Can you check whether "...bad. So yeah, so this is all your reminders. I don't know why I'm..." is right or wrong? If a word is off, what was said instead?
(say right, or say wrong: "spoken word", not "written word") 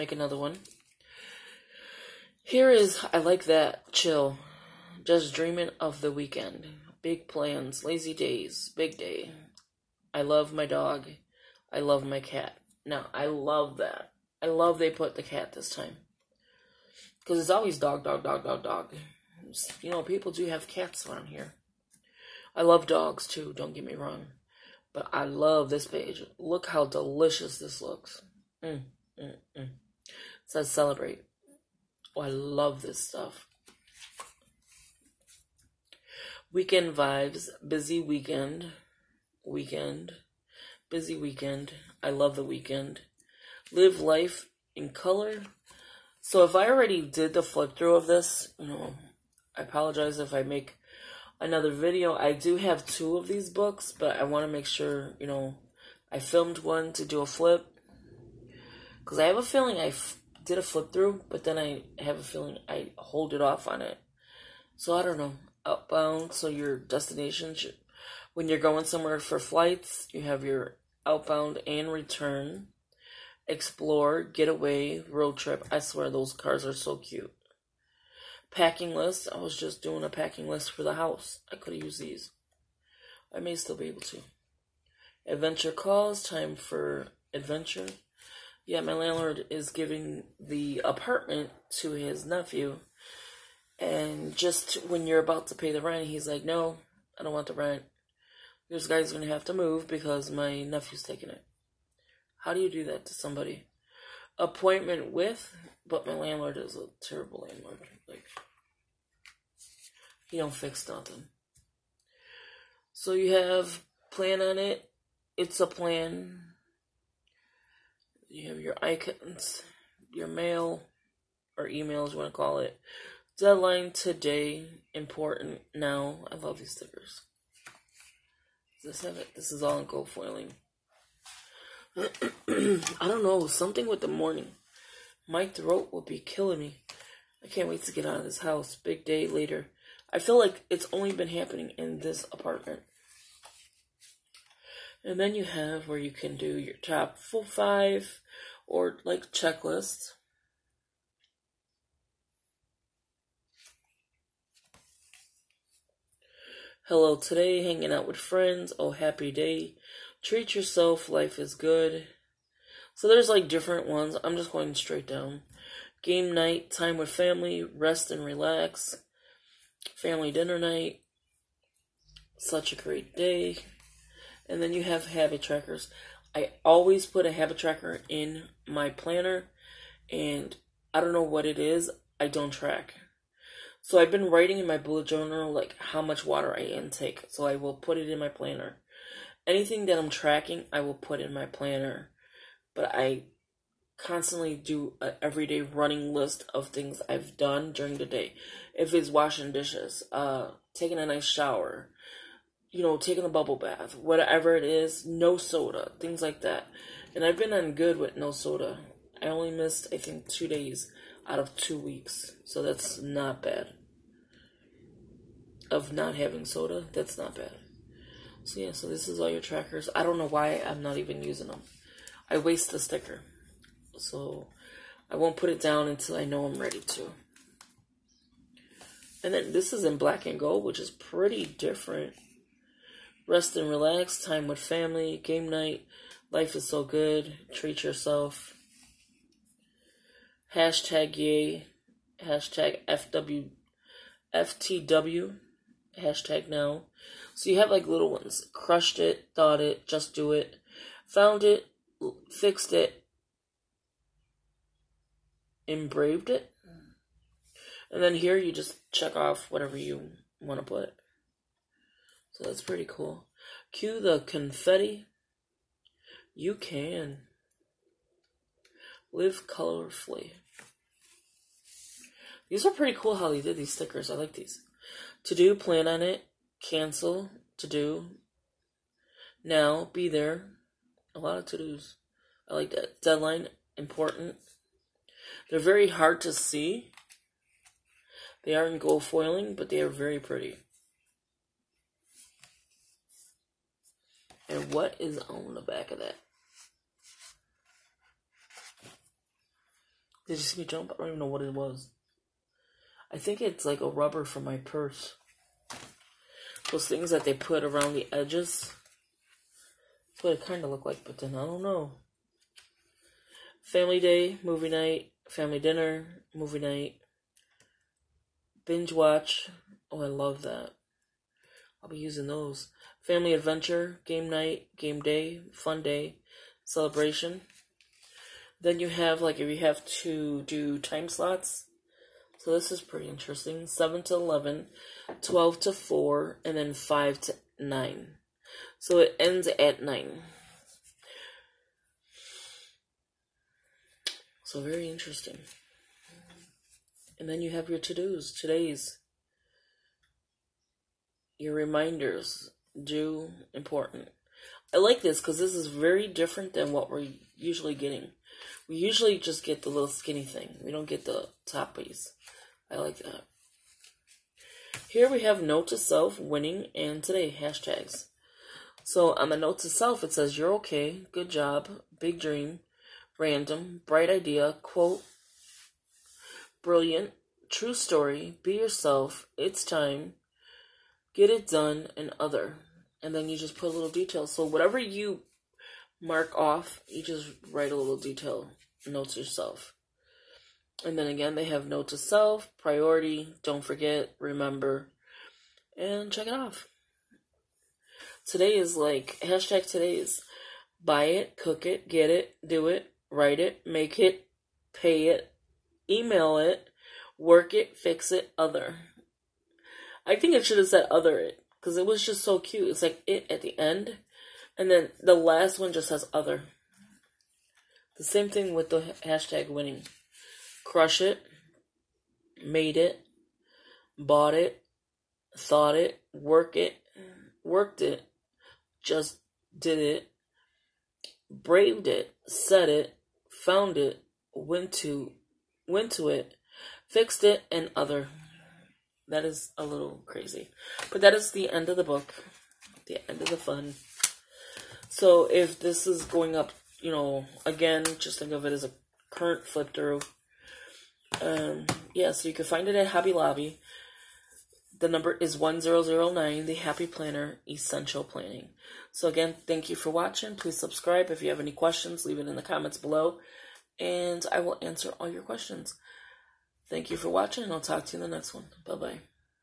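wrong: "trackers", not "reminders".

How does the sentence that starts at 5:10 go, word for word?
That's what it kind of looked like, but then I don't know.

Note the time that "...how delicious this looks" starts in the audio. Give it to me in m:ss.
0:26.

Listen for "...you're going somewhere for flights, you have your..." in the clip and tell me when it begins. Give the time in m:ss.
1:08.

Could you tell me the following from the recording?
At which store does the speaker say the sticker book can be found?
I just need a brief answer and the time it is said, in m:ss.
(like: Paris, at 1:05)
Hobby Lobby, at 7:32.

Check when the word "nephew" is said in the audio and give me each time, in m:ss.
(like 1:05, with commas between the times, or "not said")
1:32, 1:40.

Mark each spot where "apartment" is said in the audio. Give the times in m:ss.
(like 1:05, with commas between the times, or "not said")
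1:30, 2:22.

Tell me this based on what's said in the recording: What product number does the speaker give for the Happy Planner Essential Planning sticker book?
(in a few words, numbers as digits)
1009.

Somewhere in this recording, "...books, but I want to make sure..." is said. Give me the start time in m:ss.
0:53.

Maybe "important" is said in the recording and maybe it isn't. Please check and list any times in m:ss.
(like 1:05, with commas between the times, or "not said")
2:04, 4:43, 5:53.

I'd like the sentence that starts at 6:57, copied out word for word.
The same thing with the hashtag winning.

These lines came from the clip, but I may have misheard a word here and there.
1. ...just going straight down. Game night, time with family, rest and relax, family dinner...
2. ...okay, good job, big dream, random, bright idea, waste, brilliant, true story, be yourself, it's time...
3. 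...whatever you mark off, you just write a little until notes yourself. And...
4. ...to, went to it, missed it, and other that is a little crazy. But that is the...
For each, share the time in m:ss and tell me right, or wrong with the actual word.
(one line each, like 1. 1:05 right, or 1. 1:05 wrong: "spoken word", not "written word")
1. 2:44 right
2. 6:10 wrong: "quote", not "waste"
3. 6:24 wrong: "detail", not "until"
4. 7:14 wrong: "fixed", not "missed".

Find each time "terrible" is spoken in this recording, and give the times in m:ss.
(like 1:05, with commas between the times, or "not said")
1:47.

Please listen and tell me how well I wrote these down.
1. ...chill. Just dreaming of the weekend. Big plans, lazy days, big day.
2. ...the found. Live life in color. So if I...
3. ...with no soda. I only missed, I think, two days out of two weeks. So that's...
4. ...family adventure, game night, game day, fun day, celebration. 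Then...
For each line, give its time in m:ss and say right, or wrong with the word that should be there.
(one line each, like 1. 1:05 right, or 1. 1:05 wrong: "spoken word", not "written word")
1. 0:03 right
2. 0:42 wrong: "weekend", not "found"
3. 3:27 right
4. 5:23 right.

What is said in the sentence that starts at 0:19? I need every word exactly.
You know, people do have cats around here.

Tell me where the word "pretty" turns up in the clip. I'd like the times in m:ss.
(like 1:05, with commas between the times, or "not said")
3:50, 4:22, 4:32, 4:50, 5:32.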